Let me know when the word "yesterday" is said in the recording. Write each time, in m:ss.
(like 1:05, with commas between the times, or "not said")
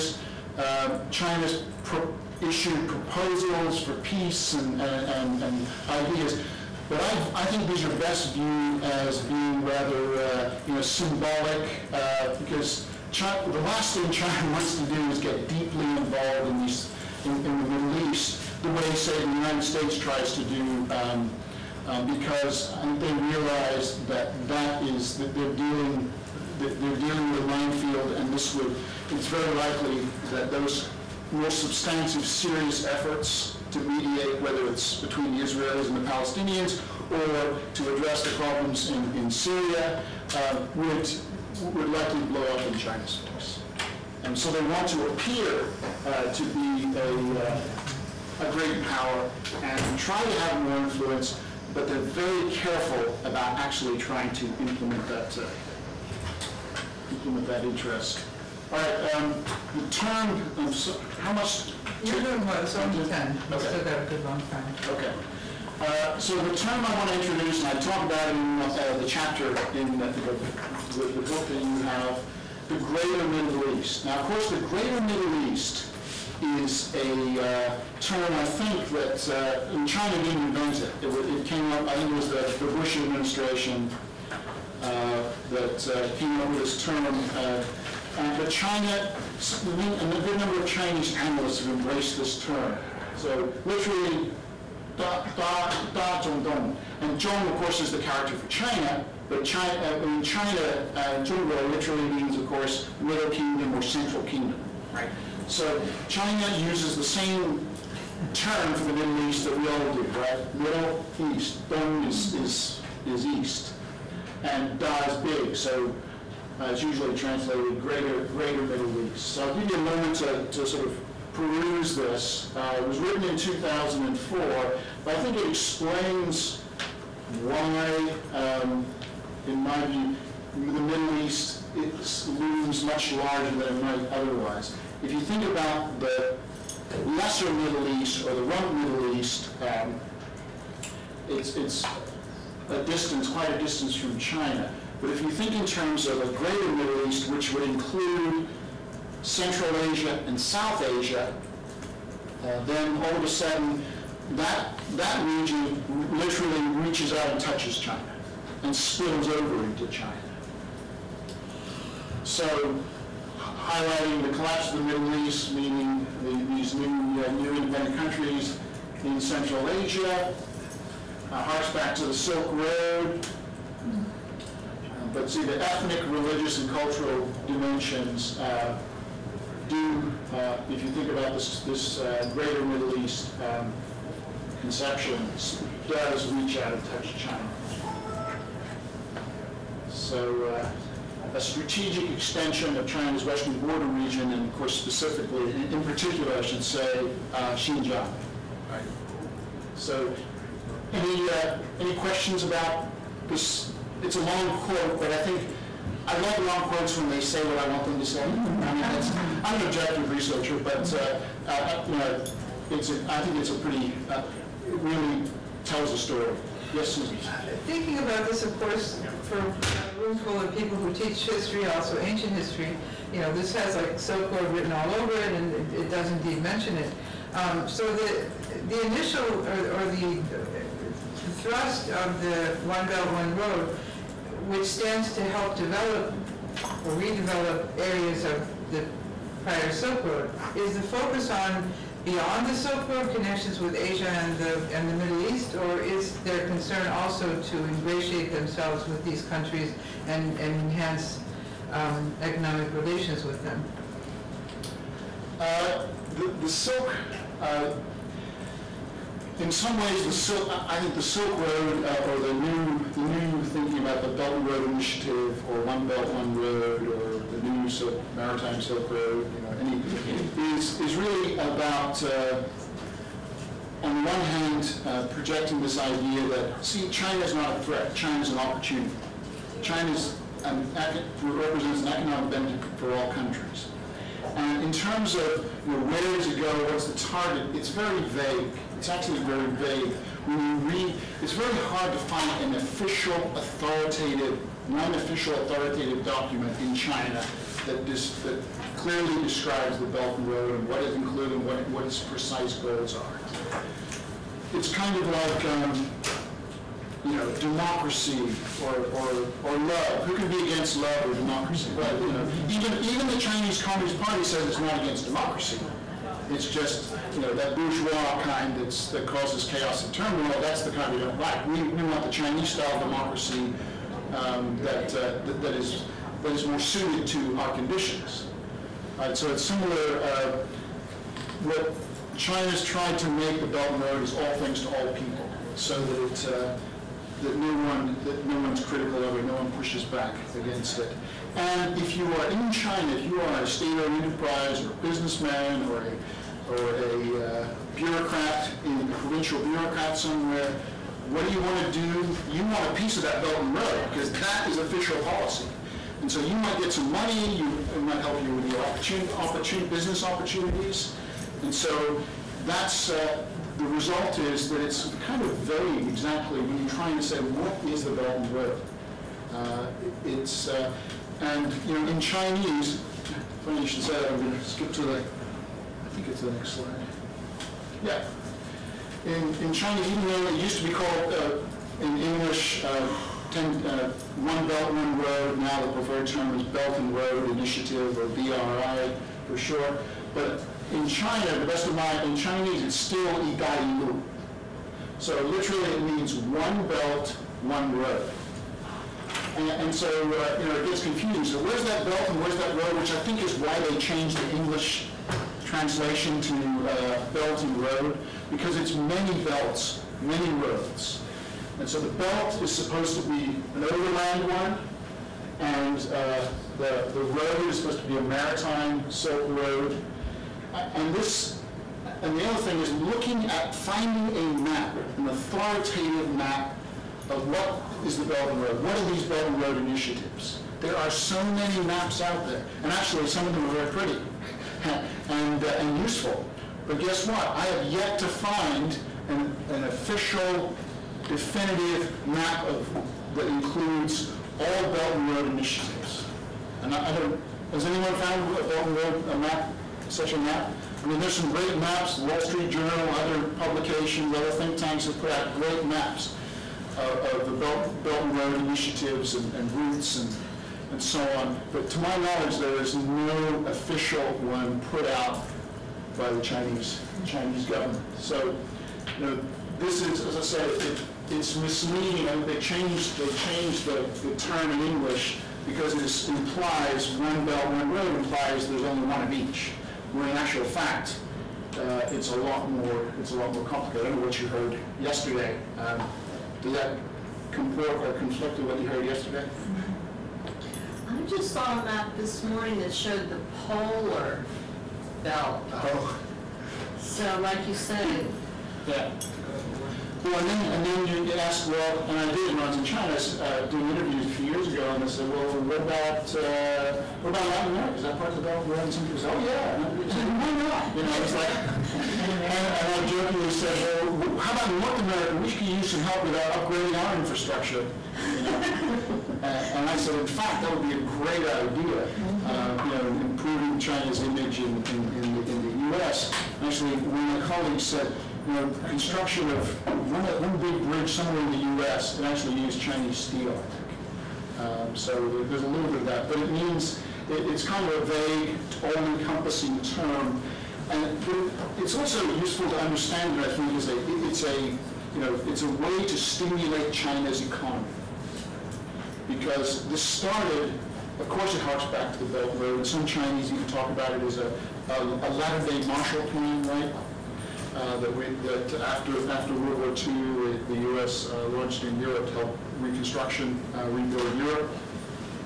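8:04, 8:08.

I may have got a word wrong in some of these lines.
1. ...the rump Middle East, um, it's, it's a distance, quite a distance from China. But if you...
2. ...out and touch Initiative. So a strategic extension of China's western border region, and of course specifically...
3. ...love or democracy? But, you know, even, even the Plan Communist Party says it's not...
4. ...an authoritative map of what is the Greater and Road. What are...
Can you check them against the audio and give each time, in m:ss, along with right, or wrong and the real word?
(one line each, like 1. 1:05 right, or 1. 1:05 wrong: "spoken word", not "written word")
1. 2:18 right
2. 3:06 wrong: "China", not "Initiative"
3. 5:10 wrong: "Chinese", not "Plan"
4. 7:04 wrong: "Belt", not "Greater".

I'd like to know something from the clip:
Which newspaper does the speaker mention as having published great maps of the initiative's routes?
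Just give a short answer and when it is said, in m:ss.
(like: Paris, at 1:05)
Wall Street Journal, at 7:31.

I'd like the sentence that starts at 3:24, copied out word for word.
It's a long quote, but I think I love long quotes when they say what I want them to say.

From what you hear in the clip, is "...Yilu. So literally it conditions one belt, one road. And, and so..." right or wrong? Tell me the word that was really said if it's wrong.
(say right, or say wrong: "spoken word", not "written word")
wrong: "means", not "conditions".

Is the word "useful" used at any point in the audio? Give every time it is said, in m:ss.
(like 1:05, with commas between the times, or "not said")
7:15, 9:02.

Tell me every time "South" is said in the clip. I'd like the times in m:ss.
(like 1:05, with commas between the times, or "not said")
2:30.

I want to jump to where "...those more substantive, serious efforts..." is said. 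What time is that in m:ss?
0:30.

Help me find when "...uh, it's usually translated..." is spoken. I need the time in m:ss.
1:56.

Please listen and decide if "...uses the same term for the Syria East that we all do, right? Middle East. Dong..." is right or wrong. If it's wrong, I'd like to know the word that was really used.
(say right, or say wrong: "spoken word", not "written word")
wrong: "Middle", not "Syria".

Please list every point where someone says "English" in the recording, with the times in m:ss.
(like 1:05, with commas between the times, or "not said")
6:21, 6:44, 7:54.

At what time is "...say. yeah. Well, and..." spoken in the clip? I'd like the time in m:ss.
8:17.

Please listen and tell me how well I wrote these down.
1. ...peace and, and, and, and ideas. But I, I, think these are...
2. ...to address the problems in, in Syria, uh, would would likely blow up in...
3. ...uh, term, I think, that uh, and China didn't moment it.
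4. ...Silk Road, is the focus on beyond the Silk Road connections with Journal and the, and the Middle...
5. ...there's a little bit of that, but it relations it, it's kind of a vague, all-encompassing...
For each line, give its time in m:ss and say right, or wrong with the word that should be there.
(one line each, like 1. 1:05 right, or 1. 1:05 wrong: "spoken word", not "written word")
1. 0:03 right
2. 0:37 right
3. 1:17 wrong: "invent", not "moment"
4. 3:59 wrong: "Asia", not "Journal"
5. 8:55 wrong: "means", not "relations".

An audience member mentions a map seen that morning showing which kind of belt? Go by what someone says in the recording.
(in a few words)
Polar belt.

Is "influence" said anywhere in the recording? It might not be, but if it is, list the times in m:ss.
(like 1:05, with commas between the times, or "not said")
0:50.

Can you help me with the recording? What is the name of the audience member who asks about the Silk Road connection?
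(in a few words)
Susan.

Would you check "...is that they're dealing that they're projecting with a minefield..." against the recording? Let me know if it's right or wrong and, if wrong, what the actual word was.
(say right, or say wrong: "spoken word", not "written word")
wrong: "dealing", not "projecting".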